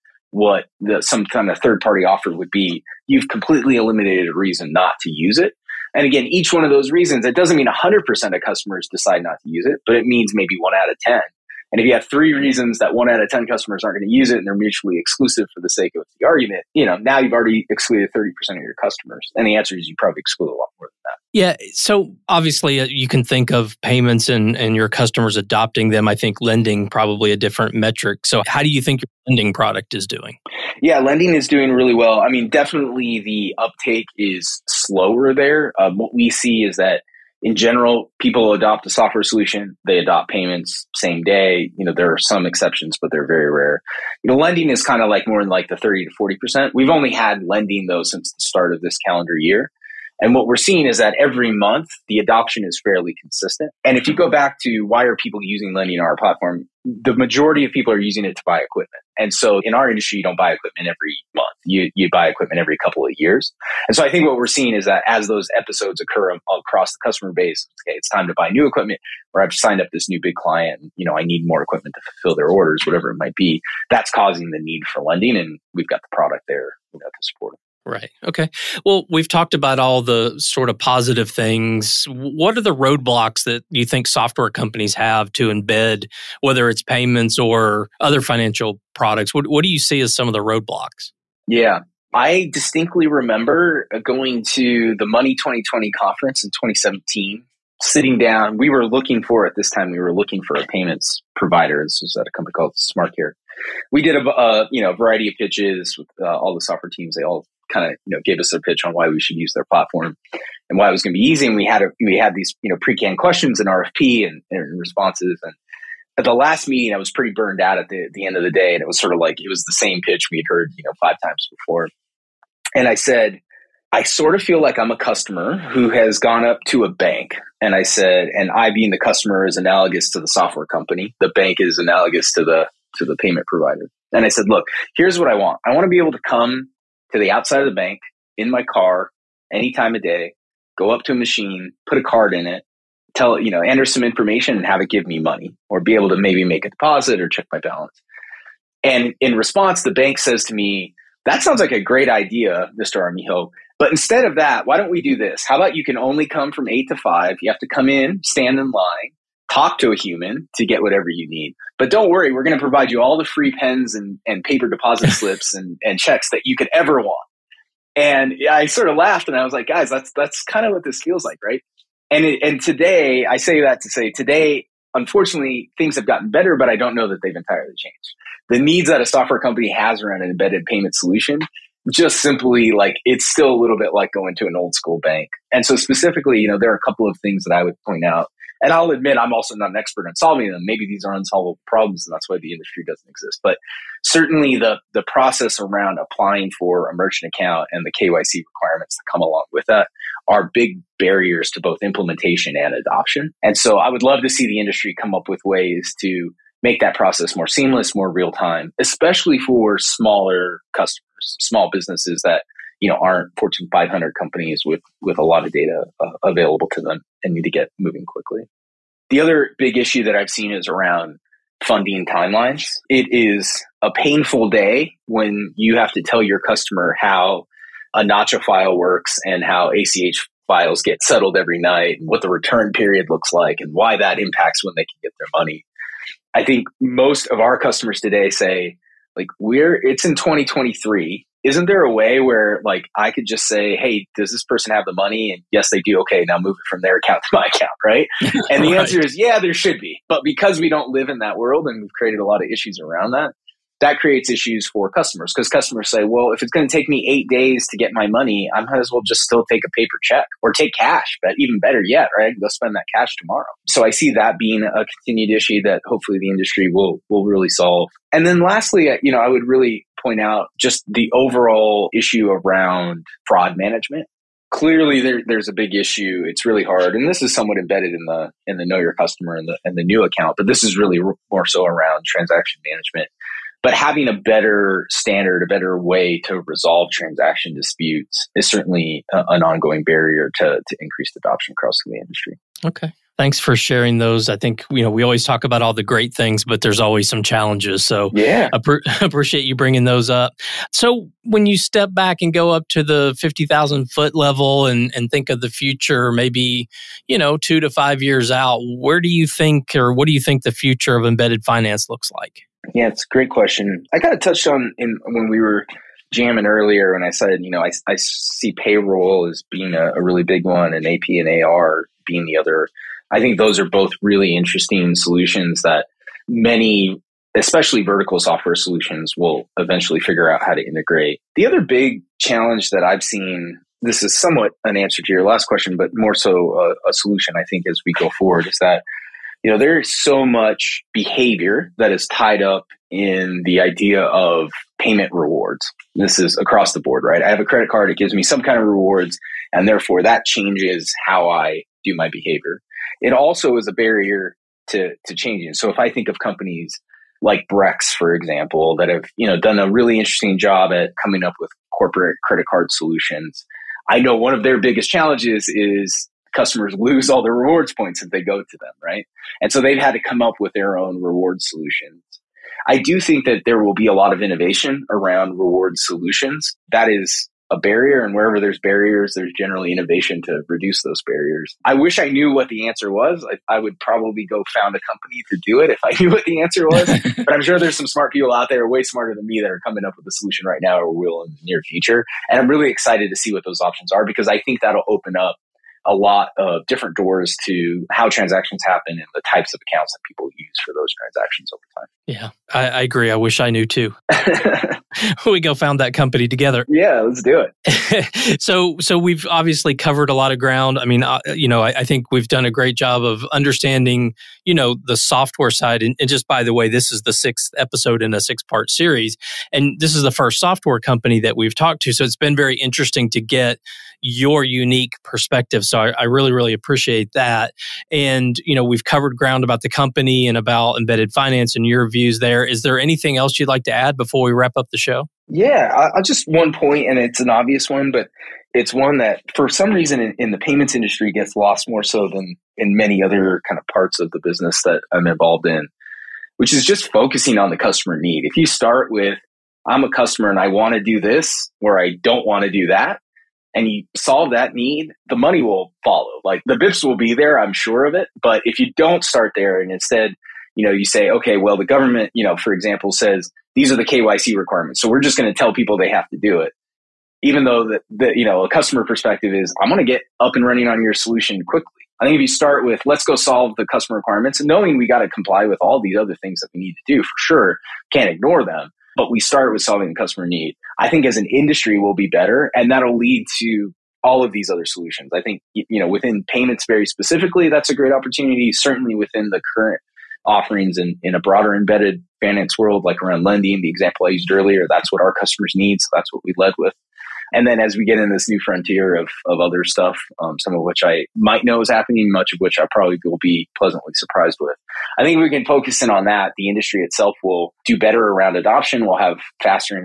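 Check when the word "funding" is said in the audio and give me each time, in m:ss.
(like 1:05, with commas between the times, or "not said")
3:41.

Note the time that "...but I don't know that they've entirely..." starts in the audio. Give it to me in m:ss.
2:56.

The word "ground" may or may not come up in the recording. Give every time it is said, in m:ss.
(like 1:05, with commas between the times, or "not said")
6:50, 7:09.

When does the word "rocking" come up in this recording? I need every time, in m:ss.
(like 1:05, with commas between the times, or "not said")
not said.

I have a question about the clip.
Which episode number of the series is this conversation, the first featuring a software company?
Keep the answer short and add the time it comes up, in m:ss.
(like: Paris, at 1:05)
6th, at 6:57.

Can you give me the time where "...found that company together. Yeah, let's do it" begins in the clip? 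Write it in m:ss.
6:45.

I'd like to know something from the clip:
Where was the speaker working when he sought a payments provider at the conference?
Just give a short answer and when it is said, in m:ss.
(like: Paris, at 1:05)
SmartCare, at 1:42.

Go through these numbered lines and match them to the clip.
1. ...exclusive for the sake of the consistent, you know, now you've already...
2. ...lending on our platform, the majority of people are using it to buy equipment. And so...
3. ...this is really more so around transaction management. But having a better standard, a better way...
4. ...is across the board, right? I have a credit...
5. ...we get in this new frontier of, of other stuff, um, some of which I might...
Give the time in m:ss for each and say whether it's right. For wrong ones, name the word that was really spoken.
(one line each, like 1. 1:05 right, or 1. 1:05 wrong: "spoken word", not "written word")
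1. 0:14 wrong: "argument", not "consistent"
2. 0:55 right
3. 4:40 right
4. 5:46 right
5. 8:17 right.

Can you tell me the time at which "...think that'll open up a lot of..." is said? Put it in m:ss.
6:34.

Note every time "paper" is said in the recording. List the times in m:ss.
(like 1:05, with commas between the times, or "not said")
2:44, 4:19.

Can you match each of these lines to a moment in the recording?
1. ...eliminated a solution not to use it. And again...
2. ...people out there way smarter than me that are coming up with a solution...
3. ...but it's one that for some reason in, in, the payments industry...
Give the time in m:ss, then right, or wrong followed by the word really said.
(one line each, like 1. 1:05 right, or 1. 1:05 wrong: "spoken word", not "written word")
1. 0:03 wrong: "reason", not "solution"
2. 6:28 right
3. 7:17 right.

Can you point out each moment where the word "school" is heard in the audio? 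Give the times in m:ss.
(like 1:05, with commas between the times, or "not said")
3:04.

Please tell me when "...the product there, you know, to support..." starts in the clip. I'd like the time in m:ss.
1:16.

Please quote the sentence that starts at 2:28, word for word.
And in response, the bank says to me, that sounds like a great idea, Mr.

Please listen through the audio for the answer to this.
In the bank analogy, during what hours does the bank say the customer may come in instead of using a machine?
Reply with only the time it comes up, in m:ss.
2:36.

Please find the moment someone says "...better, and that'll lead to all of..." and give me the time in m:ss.
8:02.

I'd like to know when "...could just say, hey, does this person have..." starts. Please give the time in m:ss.
4:03.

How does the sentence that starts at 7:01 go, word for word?
So it's been very interesting to get your unique perspective.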